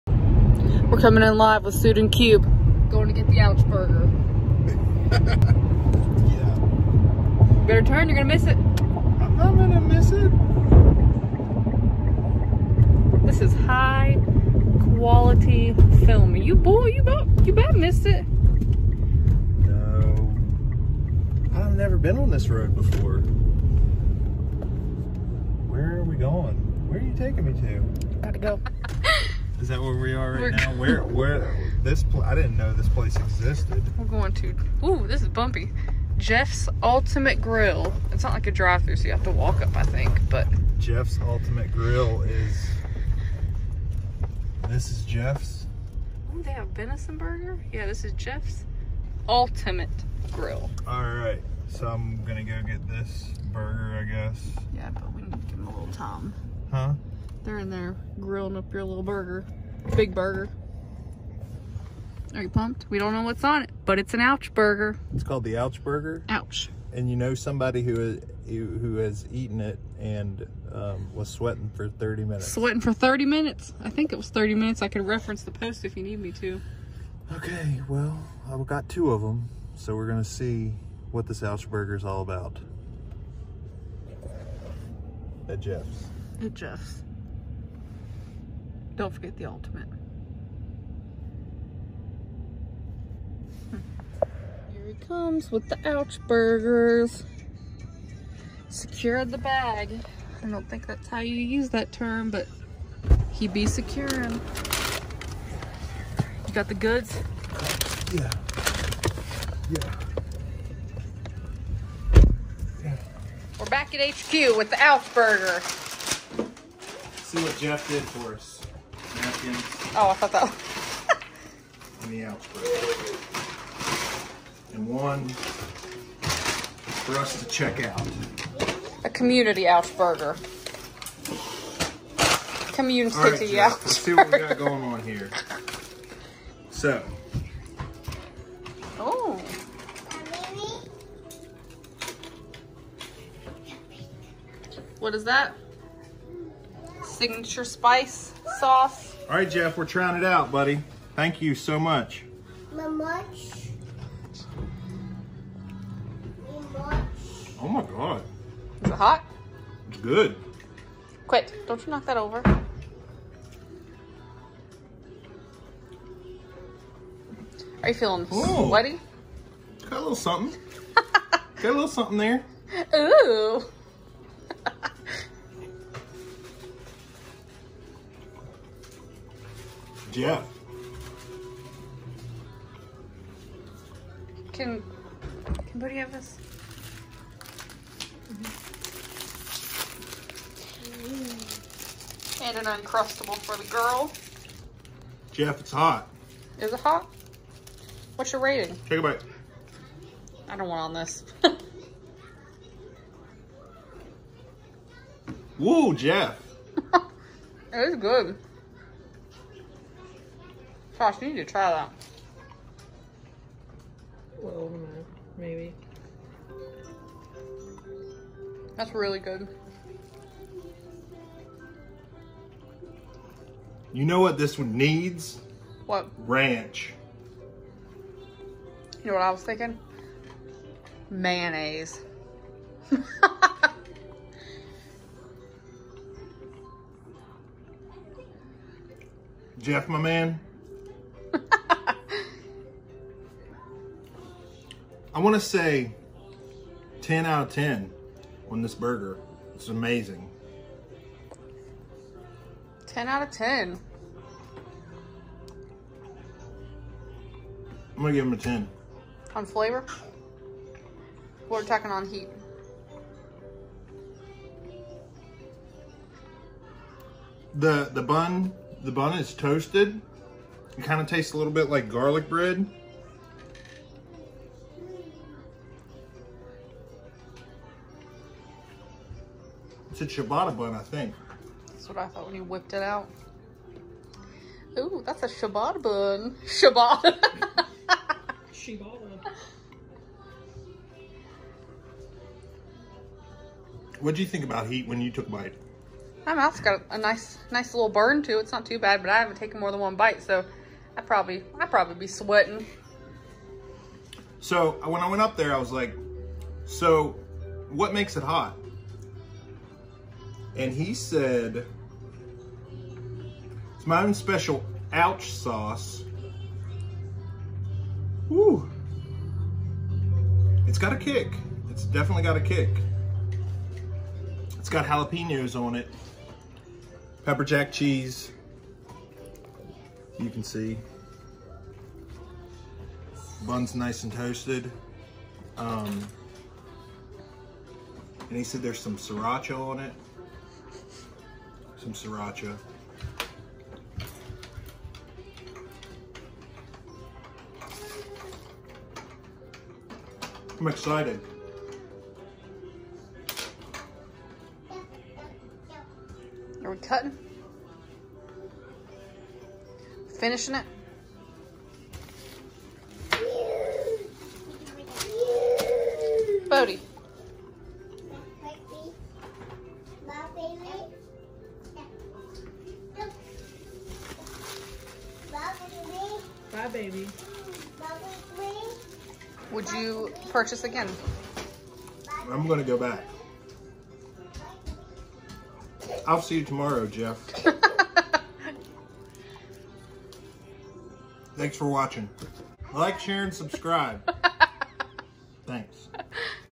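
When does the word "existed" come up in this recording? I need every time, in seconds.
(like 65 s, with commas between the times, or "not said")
33 s.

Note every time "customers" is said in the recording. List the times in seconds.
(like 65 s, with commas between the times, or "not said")
not said.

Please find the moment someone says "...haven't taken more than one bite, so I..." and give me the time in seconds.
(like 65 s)
299 s.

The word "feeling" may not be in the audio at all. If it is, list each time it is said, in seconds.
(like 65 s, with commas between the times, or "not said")
167 s.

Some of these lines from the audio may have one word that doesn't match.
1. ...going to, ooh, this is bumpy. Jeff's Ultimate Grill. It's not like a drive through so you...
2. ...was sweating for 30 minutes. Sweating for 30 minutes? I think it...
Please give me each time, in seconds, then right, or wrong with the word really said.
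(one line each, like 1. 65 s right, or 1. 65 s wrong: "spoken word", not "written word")
1. 34 s right
2. 71 s right.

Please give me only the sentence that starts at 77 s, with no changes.
Okay, well, I've got two of them, so we're going to see what this ouch burger is all about.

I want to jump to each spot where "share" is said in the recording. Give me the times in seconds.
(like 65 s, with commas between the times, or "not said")
392 s.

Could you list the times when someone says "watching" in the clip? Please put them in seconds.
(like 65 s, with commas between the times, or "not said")
391 s.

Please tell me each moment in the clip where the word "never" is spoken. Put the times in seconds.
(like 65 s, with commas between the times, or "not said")
21 s.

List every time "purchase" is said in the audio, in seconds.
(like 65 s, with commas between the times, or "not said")
380 s.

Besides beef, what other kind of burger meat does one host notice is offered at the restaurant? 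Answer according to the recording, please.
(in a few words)
Venison.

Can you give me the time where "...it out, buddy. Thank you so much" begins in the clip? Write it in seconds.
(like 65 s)
150 s.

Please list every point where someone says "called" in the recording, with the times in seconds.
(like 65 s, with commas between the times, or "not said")
65 s.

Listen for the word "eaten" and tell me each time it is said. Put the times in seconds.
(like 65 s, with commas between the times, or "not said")
69 s.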